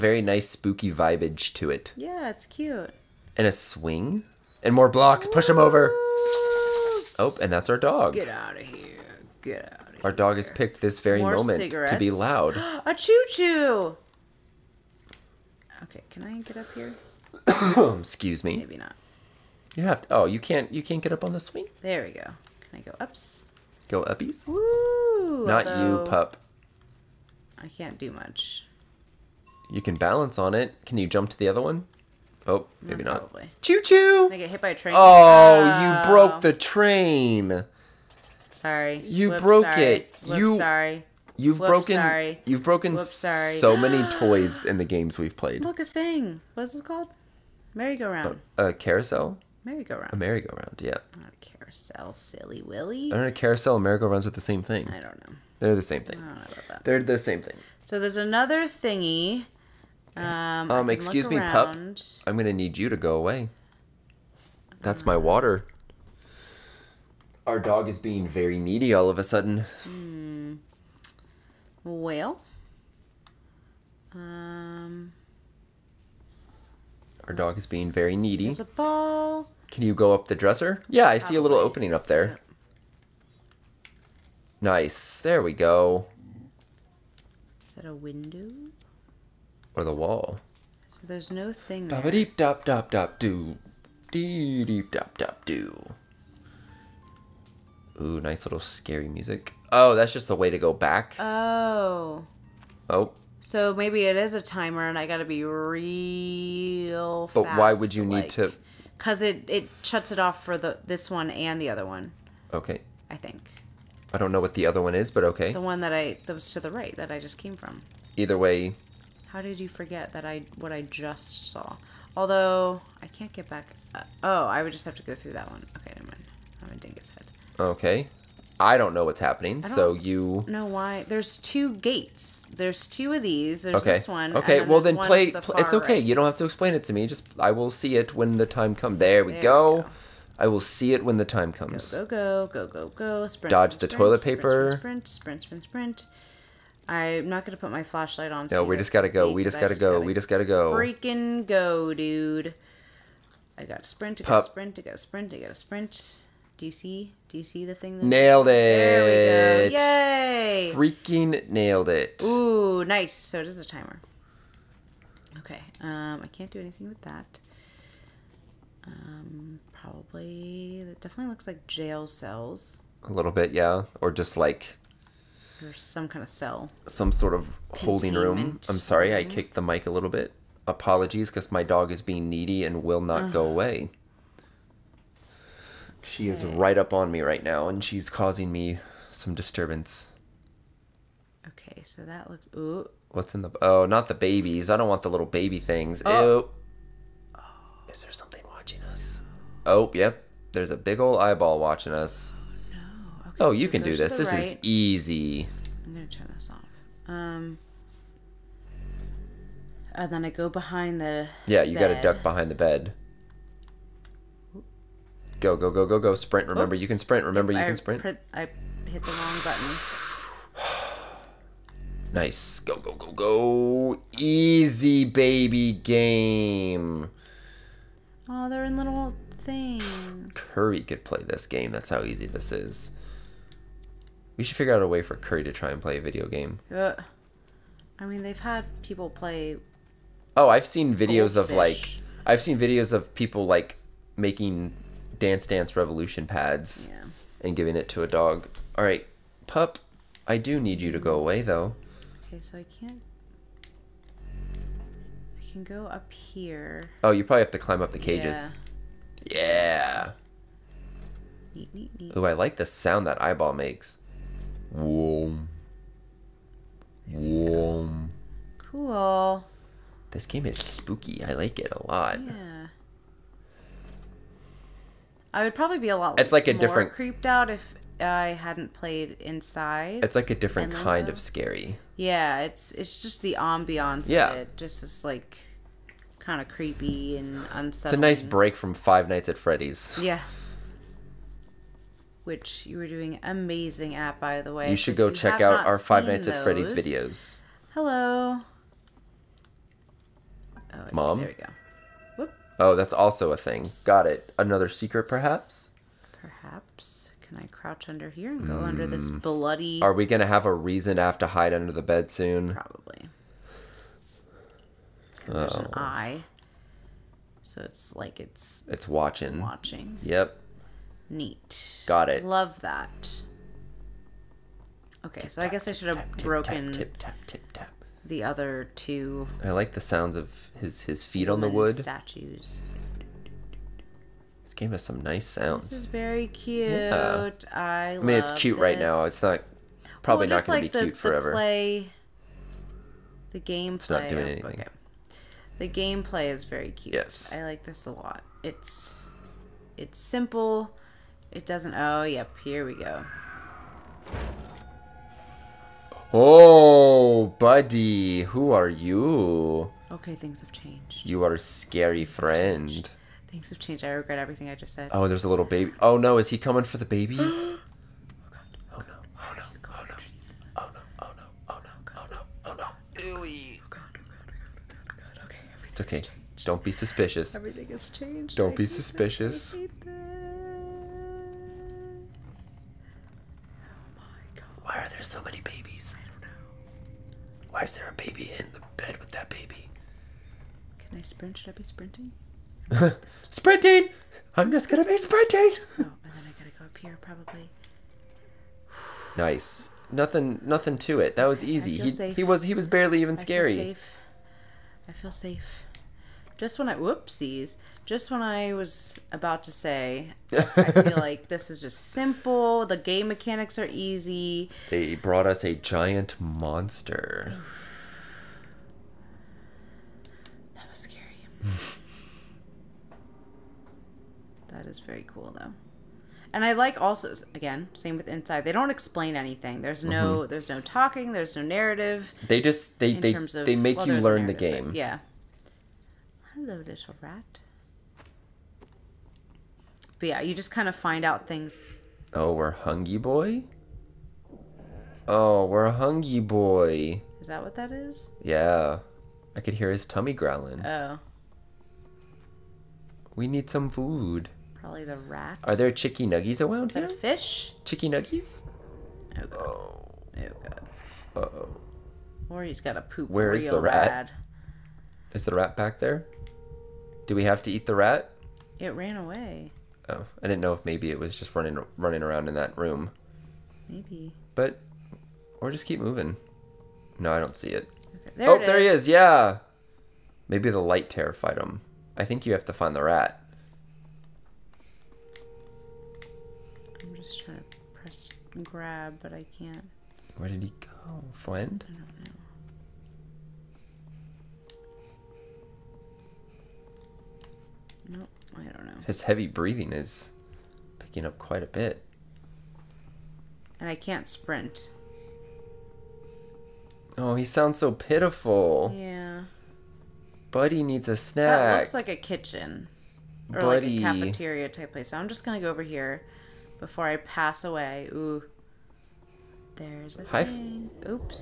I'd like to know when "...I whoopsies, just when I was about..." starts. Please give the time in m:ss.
6:46.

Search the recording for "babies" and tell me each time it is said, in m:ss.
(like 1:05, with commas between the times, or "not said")
3:14, 6:06, 6:25.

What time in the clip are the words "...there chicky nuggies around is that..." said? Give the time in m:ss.
7:35.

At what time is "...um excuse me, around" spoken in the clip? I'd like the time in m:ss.
1:00.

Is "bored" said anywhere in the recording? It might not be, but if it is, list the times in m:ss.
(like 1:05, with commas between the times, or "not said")
not said.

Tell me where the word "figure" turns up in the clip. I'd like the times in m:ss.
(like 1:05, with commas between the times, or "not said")
3:54.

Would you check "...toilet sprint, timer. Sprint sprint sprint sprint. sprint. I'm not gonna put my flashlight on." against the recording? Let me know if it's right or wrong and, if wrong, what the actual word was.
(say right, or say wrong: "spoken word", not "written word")
wrong: "paper", not "timer".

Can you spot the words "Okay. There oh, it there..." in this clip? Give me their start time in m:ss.
7:57.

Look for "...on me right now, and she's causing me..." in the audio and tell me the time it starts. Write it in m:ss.
3:06.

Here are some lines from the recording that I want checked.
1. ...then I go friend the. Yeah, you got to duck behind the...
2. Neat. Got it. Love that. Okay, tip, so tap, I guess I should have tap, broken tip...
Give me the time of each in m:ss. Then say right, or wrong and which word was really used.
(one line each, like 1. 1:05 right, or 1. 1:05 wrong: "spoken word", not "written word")
1. 3:30 wrong: "behind", not "friend"
2. 5:21 right.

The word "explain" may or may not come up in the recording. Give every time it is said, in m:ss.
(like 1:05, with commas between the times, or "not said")
2:16, 7:08.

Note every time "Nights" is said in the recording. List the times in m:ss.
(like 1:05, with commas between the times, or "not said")
4:49, 4:56.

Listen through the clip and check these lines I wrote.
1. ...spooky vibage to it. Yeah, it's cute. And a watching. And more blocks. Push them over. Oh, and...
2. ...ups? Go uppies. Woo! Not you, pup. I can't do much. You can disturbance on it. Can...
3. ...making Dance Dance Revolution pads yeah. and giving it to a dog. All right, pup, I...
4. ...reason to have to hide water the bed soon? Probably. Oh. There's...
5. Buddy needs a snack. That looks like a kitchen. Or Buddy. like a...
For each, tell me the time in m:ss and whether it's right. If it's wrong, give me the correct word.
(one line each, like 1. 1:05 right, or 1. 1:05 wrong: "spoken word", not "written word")
1. 0:00 wrong: "swing", not "watching"
2. 0:22 wrong: "balance", not "disturbance"
3. 4:04 right
4. 5:10 wrong: "under", not "water"
5. 8:30 right.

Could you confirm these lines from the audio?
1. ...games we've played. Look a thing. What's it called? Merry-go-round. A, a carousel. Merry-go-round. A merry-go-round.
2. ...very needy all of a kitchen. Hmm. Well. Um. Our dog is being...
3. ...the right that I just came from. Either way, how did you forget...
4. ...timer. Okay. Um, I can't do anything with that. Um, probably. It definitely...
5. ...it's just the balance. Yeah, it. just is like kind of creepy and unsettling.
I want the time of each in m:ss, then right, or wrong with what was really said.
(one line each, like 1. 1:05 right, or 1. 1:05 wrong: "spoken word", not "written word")
1. 0:44 right
2. 1:08 wrong: "sudden", not "kitchen"
3. 1:56 right
4. 2:43 right
5. 4:42 wrong: "ambiance", not "balance".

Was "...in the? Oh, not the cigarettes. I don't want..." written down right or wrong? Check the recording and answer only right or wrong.
wrong.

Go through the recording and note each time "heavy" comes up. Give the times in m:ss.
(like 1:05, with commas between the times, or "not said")
8:19.